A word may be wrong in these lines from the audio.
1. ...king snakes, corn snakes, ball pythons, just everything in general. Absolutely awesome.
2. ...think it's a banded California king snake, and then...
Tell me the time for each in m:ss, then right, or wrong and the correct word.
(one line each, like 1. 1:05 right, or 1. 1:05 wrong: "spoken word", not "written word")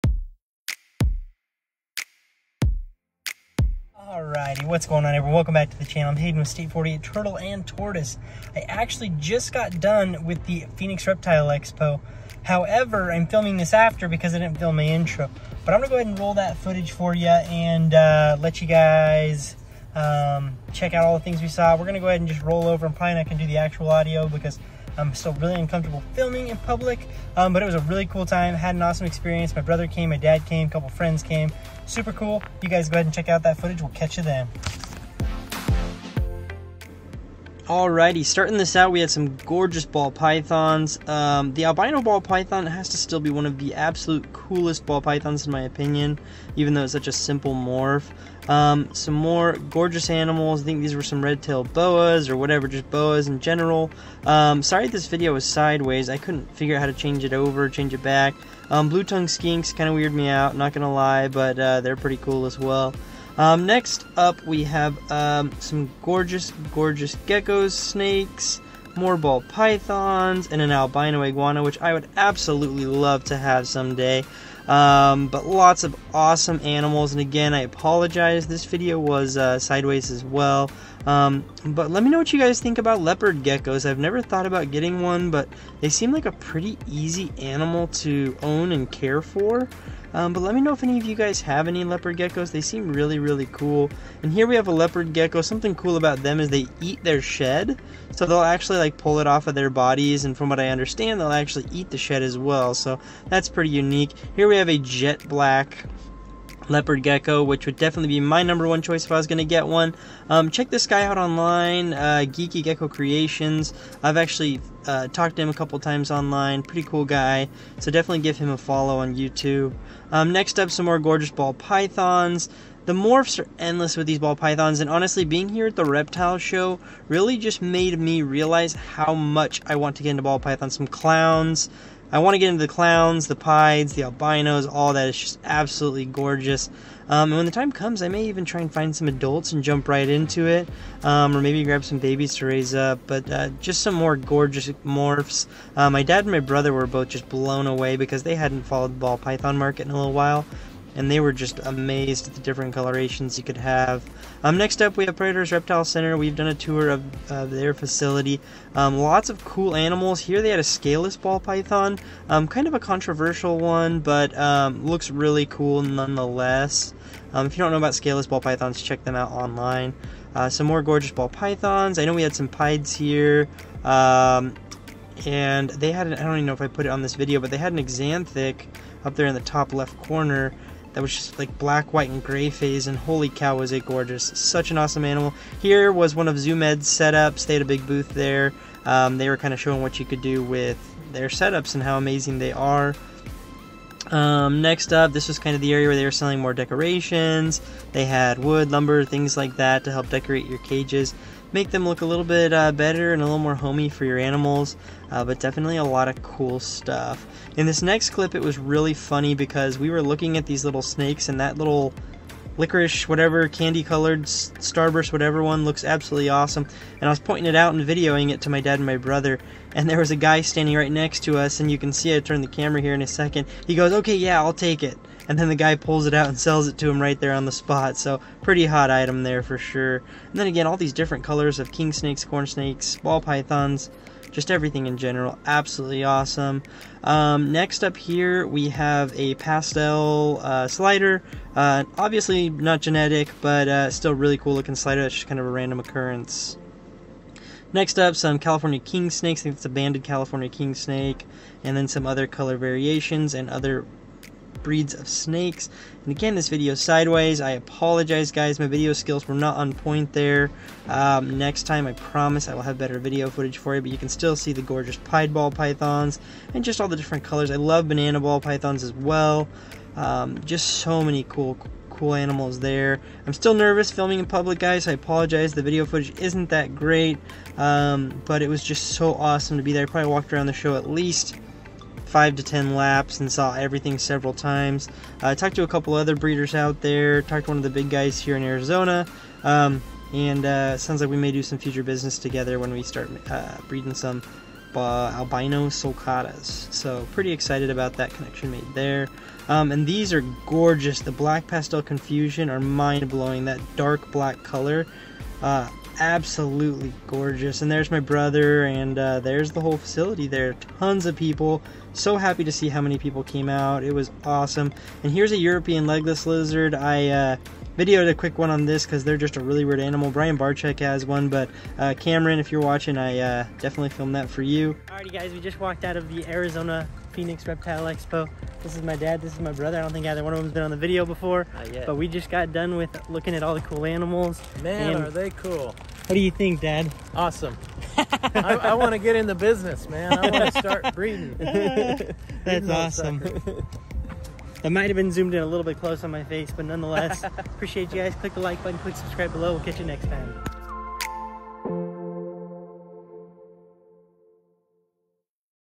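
1. 3:51 right
2. 4:09 right.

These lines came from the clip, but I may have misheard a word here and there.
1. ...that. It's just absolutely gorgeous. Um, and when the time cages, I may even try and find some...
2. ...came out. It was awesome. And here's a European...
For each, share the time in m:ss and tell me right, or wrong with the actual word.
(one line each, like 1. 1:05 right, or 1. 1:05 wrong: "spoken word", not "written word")
1. 2:14 wrong: "comes", not "cages"
2. 5:13 right.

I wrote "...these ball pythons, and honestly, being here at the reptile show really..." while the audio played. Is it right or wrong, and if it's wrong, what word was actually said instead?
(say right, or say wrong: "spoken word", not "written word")
right.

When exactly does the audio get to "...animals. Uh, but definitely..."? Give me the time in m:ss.
3:24.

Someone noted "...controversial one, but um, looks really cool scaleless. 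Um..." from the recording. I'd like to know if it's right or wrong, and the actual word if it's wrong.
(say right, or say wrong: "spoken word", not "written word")
wrong: "nonetheless", not "scaleless".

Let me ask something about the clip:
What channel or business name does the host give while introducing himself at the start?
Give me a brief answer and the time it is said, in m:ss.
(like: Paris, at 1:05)
State 48 Turtle and Tortoise, at 0:06.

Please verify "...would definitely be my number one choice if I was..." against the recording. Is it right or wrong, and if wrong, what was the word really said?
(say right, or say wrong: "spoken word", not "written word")
right.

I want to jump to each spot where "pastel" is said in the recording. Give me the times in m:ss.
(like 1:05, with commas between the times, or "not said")
3:59, 5:01.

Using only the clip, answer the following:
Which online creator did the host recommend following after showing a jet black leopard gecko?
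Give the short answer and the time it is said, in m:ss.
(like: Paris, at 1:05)
Geeky Gecko Creations, at 1:52.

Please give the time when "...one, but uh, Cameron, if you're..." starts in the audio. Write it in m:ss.
5:21.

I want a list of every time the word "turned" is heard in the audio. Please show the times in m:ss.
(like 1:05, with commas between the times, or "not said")
3:42.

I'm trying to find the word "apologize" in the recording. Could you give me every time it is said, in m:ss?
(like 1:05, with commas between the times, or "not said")
1:17, 4:17, 4:34.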